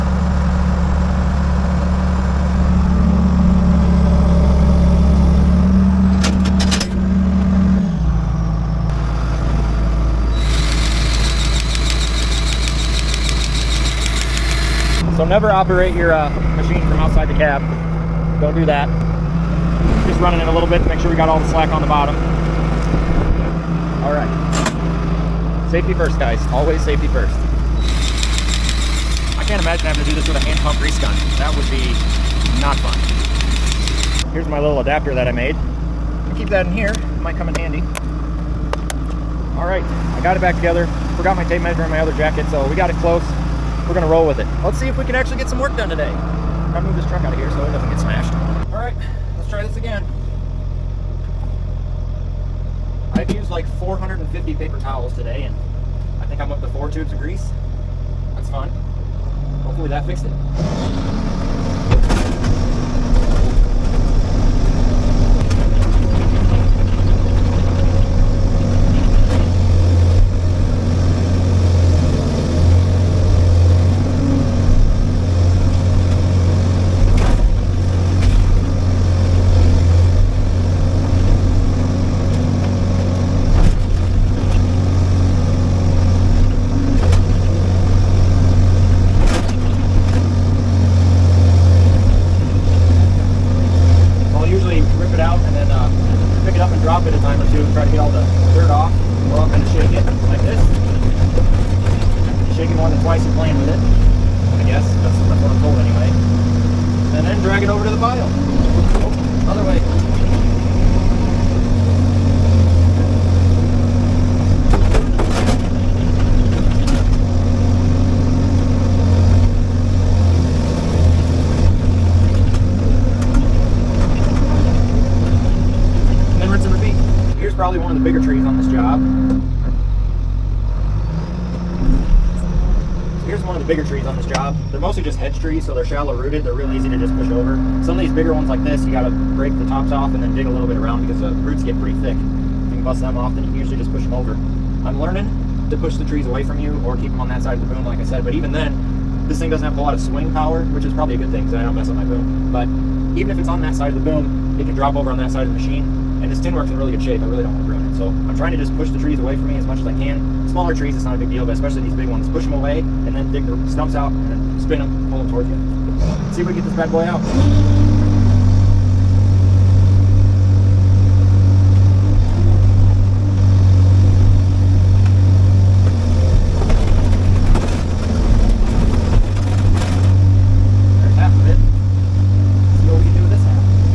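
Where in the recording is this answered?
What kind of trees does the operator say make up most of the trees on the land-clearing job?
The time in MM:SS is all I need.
02:15.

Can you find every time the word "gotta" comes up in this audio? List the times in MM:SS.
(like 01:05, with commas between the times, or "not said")
00:46, 02:18.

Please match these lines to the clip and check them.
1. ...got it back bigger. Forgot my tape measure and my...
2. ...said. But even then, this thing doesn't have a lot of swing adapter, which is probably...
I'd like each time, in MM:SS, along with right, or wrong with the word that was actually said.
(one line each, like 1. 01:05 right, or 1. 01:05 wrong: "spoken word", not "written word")
1. 00:40 wrong: "together", not "bigger"
2. 02:28 wrong: "power", not "adapter".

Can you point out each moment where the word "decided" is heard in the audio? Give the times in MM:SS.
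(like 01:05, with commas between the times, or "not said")
not said.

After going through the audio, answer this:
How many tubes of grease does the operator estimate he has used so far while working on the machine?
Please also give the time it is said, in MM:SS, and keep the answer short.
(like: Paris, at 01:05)
4, at 00:56.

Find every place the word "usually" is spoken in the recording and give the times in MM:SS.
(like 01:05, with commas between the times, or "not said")
02:23.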